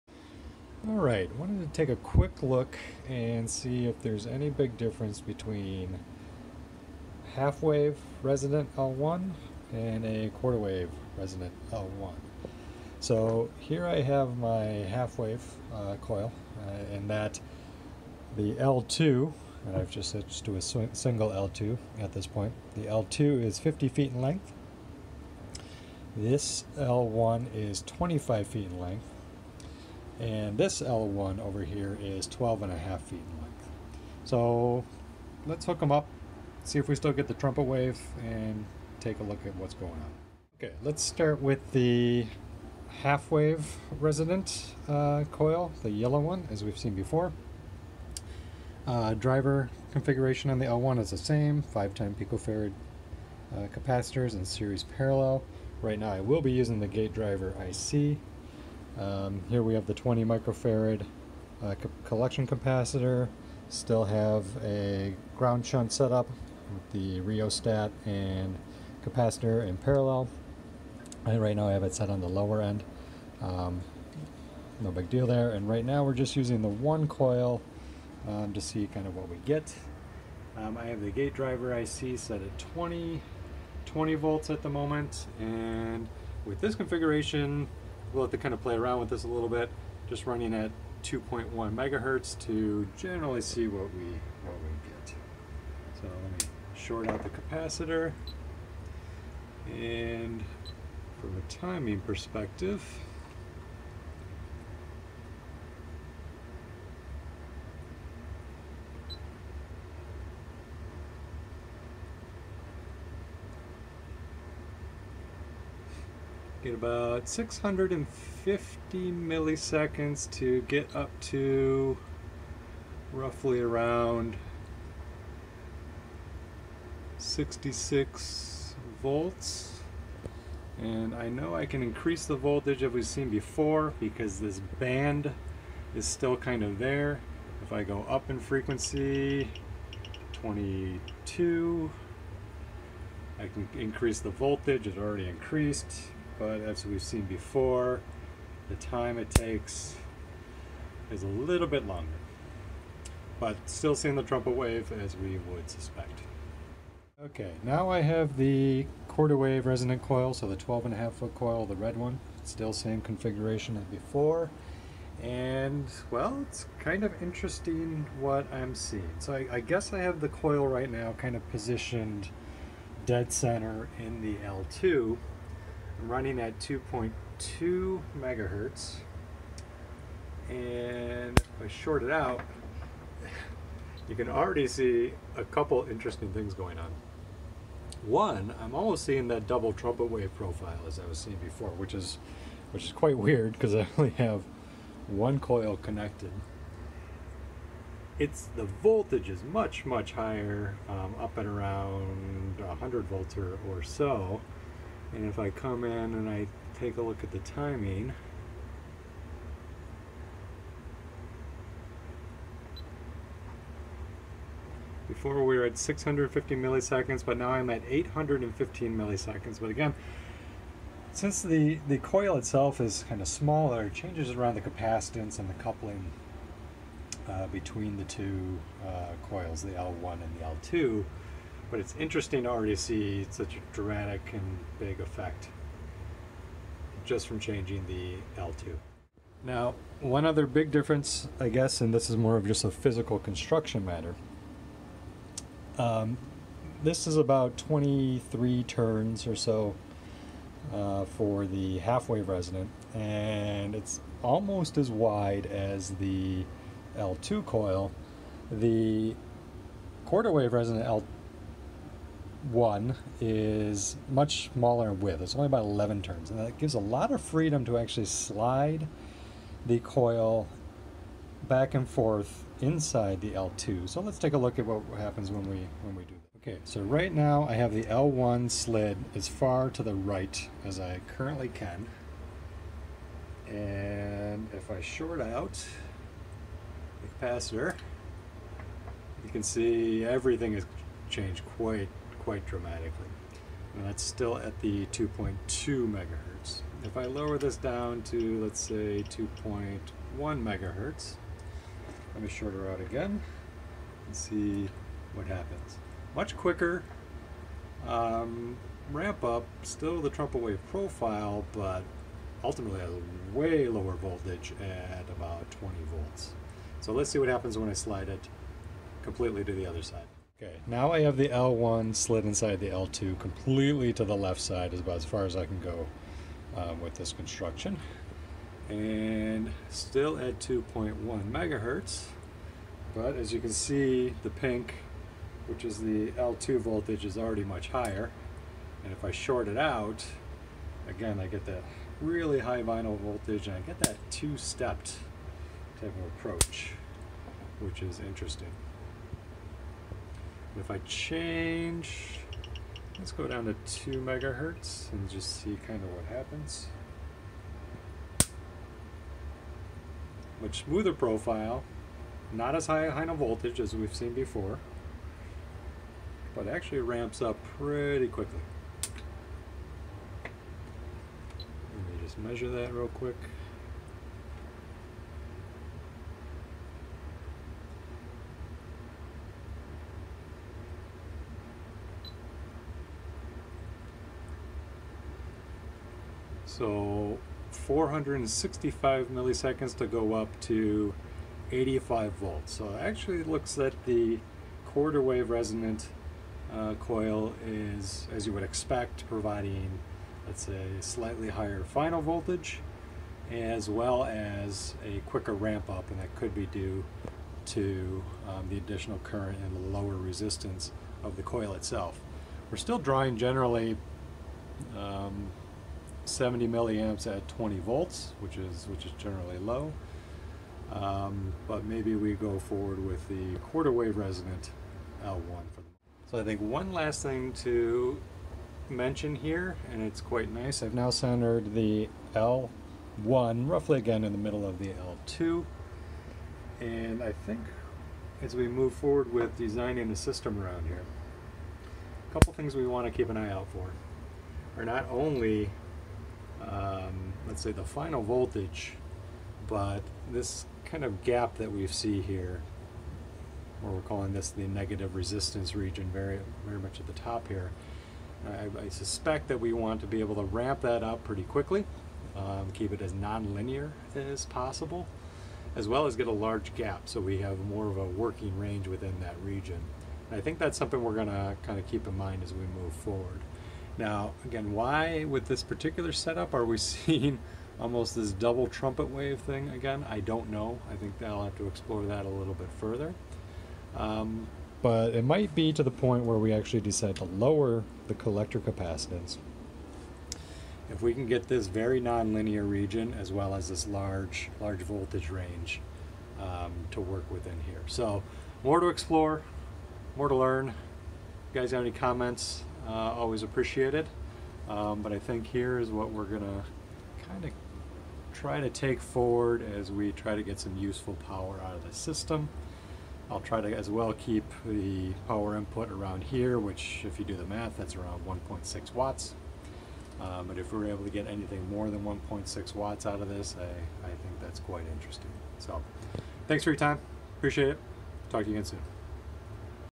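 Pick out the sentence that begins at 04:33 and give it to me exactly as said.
So let's take a look at what happens when we when we do that.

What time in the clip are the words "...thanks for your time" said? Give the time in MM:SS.
08:46.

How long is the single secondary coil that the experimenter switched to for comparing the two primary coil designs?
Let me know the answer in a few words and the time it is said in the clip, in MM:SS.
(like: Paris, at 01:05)
50 feet, at 00:23.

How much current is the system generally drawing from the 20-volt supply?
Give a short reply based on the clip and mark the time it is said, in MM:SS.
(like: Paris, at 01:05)
70 milliamps, at 06:56.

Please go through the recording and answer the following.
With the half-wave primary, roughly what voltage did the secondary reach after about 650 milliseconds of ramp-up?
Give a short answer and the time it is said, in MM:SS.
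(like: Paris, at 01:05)
66 volts, at 02:07.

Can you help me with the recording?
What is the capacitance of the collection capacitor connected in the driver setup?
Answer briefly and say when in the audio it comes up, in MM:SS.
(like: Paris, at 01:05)
20 microfarad, at 00:59.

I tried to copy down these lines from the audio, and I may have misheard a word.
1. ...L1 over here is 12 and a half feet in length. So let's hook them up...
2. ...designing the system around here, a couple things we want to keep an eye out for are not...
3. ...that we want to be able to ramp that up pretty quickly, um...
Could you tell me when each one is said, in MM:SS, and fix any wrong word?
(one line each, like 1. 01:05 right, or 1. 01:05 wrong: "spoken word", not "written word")
1. 00:30 right
2. 07:19 right
3. 07:39 right.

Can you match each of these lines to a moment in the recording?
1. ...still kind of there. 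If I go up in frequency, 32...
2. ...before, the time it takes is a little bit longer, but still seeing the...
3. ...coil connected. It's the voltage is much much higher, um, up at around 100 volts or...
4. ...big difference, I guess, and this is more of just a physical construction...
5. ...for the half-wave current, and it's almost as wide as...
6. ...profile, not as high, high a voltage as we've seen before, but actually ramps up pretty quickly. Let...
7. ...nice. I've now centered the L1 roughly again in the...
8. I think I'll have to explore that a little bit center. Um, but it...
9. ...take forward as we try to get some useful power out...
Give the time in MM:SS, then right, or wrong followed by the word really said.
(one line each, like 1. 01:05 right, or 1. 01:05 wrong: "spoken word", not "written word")
1. 02:16 wrong: "22", not "32"
2. 02:27 right
3. 03:15 right
4. 04:00 right
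5. 04:11 wrong: "resonant", not "current"
6. 06:00 right
7. 07:10 right
8. 08:00 wrong: "further", not "center"
9. 08:28 right.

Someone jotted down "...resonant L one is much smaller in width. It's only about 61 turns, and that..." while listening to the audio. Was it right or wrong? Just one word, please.
wrong.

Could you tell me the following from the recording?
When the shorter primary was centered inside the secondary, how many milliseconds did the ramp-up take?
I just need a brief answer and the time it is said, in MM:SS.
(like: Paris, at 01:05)
815 milliseconds, at 03:37.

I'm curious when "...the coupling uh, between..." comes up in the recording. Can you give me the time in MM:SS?
03:45.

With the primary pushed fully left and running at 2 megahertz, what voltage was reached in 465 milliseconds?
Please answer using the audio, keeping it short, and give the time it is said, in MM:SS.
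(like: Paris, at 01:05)
85 volts, at 06:31.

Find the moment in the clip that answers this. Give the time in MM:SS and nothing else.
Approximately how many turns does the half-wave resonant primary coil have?
04:07.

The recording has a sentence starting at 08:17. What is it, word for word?
So more to explore, more to learn.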